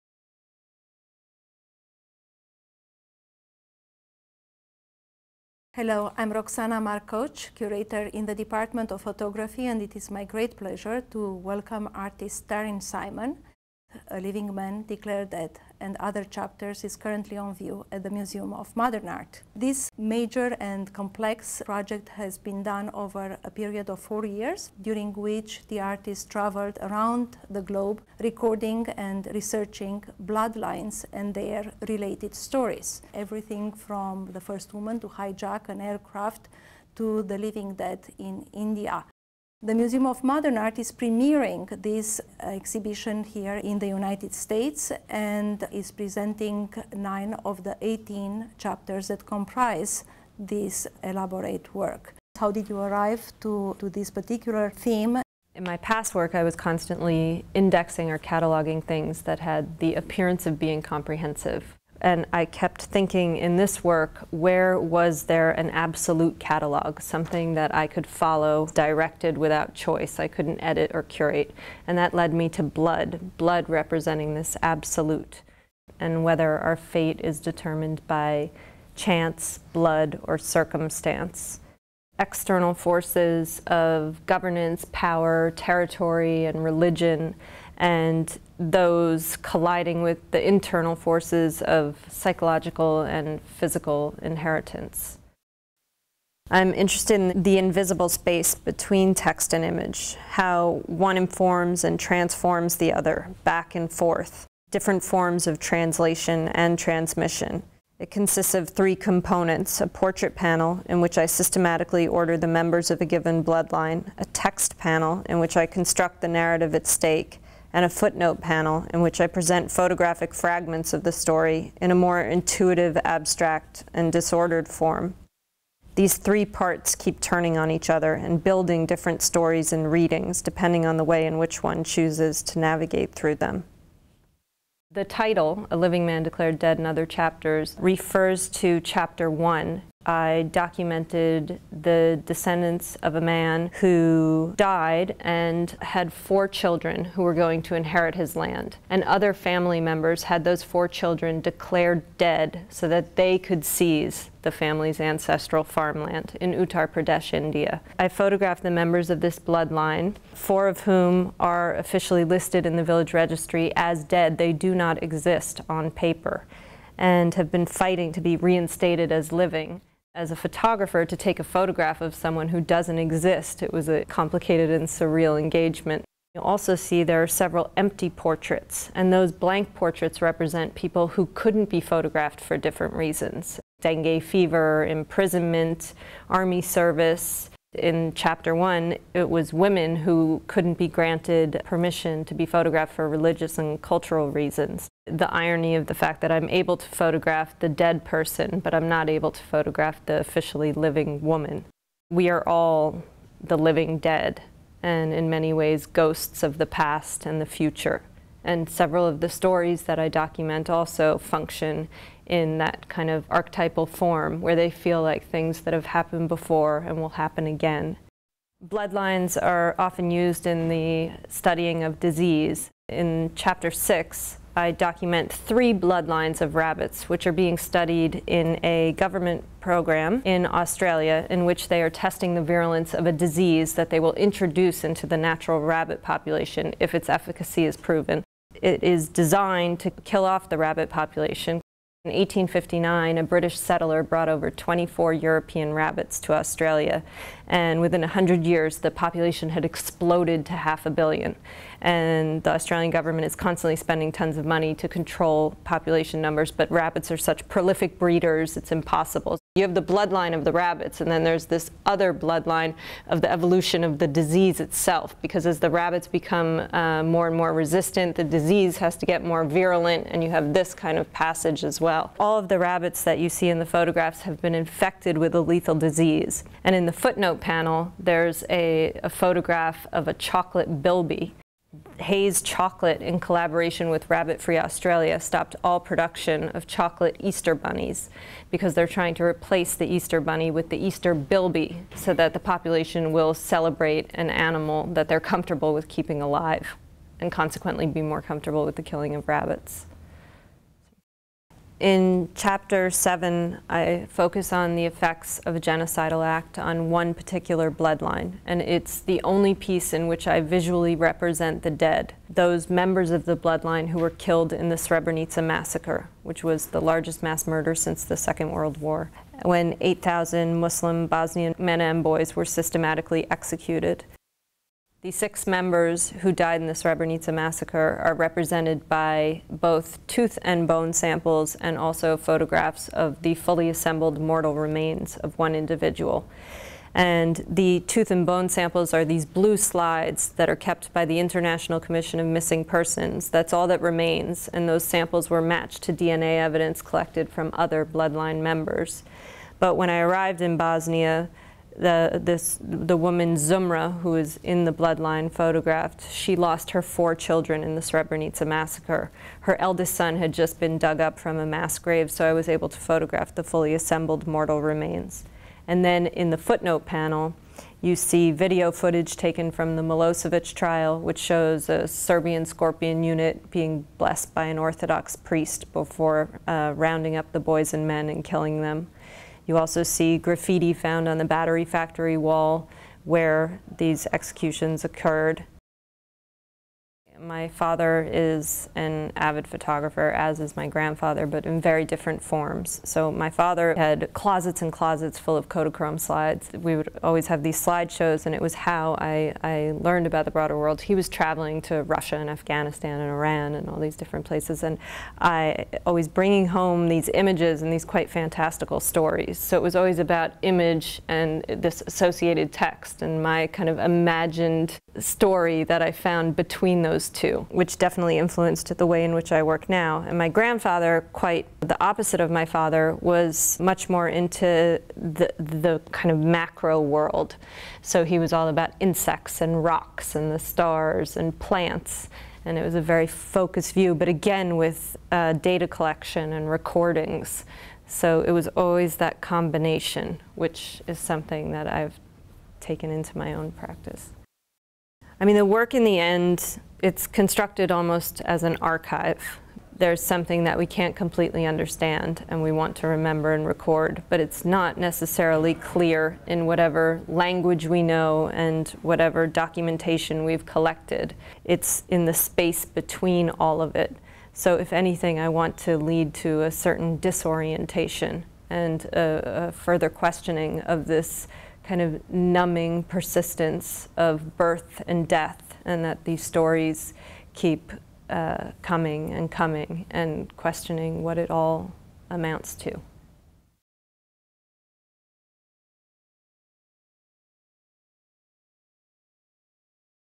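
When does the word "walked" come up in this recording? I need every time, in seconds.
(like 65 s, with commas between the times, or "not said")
not said.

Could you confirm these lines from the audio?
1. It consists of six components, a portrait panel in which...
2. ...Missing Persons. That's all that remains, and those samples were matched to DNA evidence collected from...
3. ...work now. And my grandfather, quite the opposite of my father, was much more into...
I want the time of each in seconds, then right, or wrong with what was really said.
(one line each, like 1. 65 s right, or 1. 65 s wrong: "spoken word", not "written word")
1. 107 s wrong: "three", not "six"
2. 342 s right
3. 419 s right.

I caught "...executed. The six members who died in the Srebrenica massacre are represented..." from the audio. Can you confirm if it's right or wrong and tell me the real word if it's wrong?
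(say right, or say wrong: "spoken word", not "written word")
right.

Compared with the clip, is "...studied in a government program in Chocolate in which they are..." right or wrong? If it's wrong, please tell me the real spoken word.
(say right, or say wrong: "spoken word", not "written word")
wrong: "Australia", not "Chocolate".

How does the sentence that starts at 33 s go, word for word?
Everything from the first woman to hijack an aircraft to the living dead in India.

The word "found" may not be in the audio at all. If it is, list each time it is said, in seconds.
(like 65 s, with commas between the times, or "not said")
380 s, 415 s.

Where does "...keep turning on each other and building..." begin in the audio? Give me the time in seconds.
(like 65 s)
126 s.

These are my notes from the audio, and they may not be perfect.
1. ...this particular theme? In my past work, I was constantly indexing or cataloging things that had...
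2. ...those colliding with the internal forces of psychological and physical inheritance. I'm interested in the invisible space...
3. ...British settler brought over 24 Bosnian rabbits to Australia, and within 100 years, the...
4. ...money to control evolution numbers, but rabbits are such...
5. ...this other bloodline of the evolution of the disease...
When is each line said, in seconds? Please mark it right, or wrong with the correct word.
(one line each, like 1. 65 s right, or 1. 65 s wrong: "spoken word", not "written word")
1. 53 s right
2. 88 s right
3. 243 s wrong: "European", not "Bosnian"
4. 254 s wrong: "population", not "evolution"
5. 261 s right.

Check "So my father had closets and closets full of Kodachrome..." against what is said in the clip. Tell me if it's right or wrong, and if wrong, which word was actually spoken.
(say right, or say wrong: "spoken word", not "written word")
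right.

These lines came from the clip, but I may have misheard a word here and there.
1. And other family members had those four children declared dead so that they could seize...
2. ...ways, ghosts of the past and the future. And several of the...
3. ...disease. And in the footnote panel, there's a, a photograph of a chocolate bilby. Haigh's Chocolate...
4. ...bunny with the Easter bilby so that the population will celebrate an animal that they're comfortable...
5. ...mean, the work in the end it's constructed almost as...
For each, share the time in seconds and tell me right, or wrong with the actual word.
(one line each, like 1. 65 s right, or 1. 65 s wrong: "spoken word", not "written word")
1. 148 s right
2. 205 s right
3. 275 s right
4. 290 s right
5. 445 s right.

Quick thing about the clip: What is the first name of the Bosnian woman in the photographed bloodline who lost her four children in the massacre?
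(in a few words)
Zumra.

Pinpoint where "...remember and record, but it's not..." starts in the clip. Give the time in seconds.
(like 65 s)
452 s.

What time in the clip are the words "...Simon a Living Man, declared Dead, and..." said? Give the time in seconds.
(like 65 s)
12 s.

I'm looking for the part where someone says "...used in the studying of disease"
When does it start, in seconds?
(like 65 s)
220 s.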